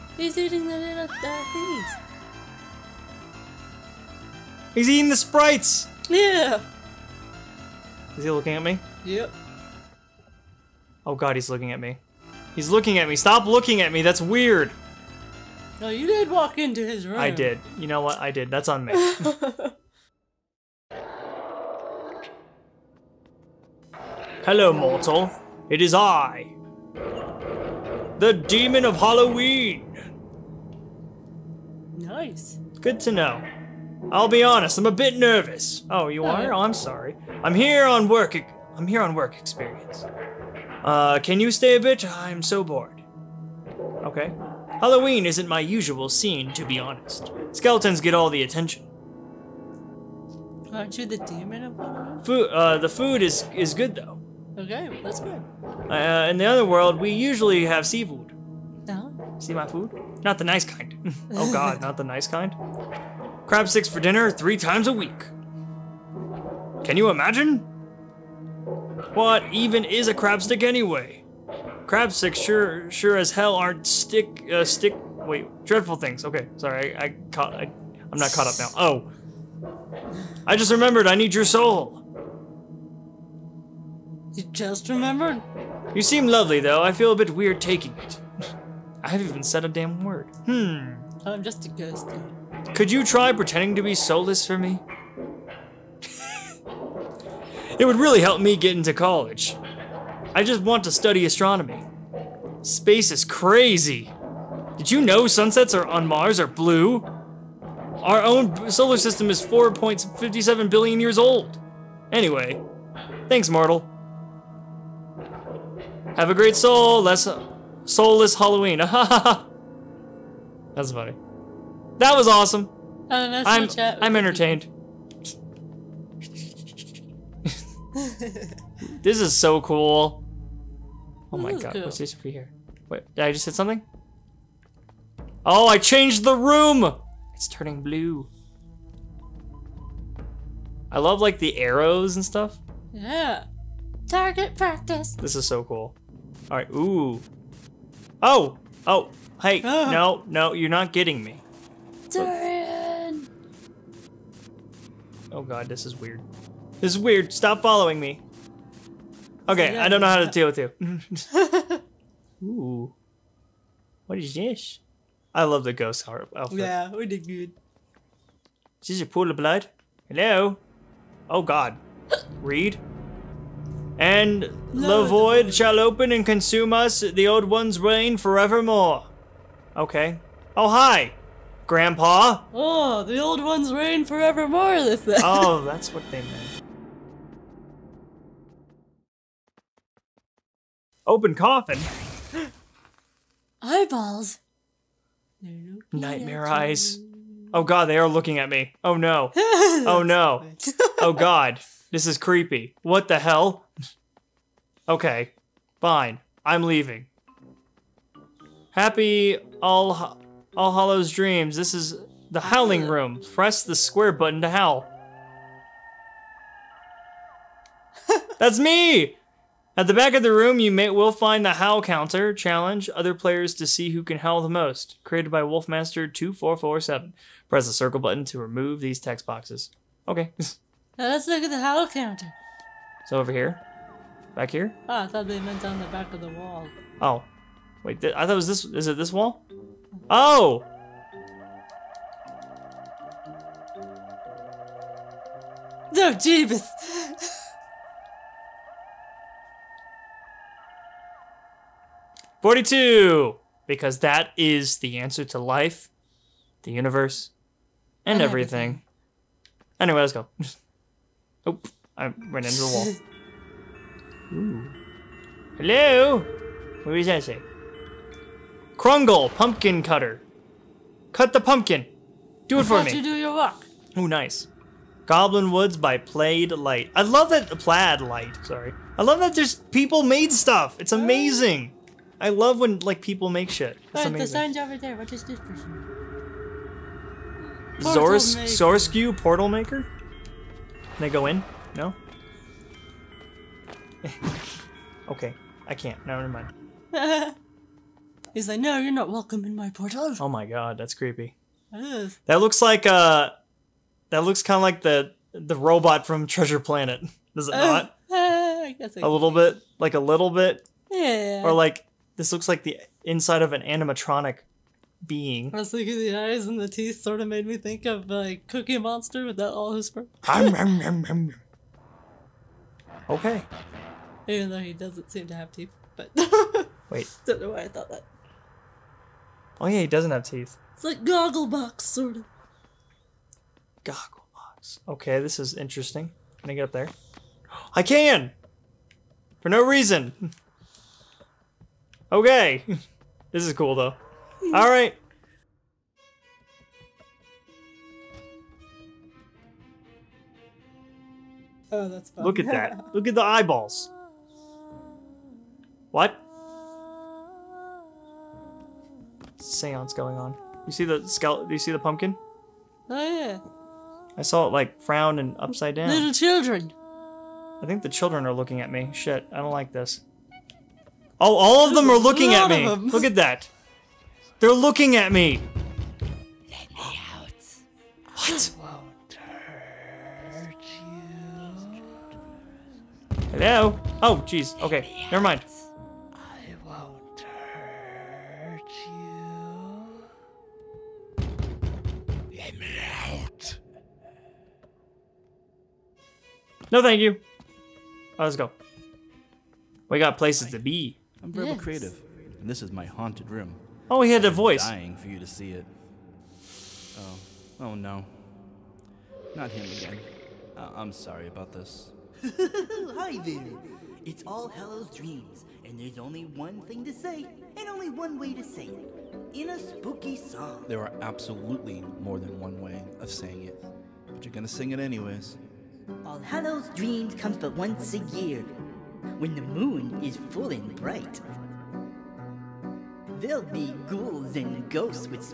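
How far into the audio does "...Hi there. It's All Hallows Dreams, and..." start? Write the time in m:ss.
6:52.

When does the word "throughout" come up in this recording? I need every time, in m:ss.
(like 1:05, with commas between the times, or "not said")
not said.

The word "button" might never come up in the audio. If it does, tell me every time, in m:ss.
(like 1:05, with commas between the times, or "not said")
3:34, 3:47.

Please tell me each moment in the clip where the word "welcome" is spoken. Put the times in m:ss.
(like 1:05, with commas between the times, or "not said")
4:59.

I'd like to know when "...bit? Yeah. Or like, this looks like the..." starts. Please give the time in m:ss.
5:10.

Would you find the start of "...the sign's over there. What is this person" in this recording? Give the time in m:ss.
4:44.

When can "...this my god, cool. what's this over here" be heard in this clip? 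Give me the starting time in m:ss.
2:11.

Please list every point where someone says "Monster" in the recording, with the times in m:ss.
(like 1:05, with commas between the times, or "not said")
5:18.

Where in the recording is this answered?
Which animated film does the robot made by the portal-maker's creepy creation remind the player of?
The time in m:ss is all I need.
5:06.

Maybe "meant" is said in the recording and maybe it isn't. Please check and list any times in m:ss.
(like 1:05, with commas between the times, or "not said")
3:06, 3:55.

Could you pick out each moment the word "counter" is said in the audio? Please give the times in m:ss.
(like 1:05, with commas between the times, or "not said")
3:41, 3:51.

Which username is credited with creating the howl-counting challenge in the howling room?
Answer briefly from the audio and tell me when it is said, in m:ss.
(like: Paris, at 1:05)
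Wolfmaster2447, at 3:45.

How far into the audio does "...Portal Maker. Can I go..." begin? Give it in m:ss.
4:49.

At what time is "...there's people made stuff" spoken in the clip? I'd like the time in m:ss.
4:39.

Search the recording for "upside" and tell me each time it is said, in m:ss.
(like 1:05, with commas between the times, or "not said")
6:05.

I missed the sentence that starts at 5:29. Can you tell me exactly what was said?
Oh yeah, he doesn't have teeth.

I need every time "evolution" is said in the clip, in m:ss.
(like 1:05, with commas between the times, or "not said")
not said.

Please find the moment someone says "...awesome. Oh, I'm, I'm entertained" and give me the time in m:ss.
2:02.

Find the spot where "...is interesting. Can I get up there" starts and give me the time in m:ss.
5:35.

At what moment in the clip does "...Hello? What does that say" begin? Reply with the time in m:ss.
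4:25.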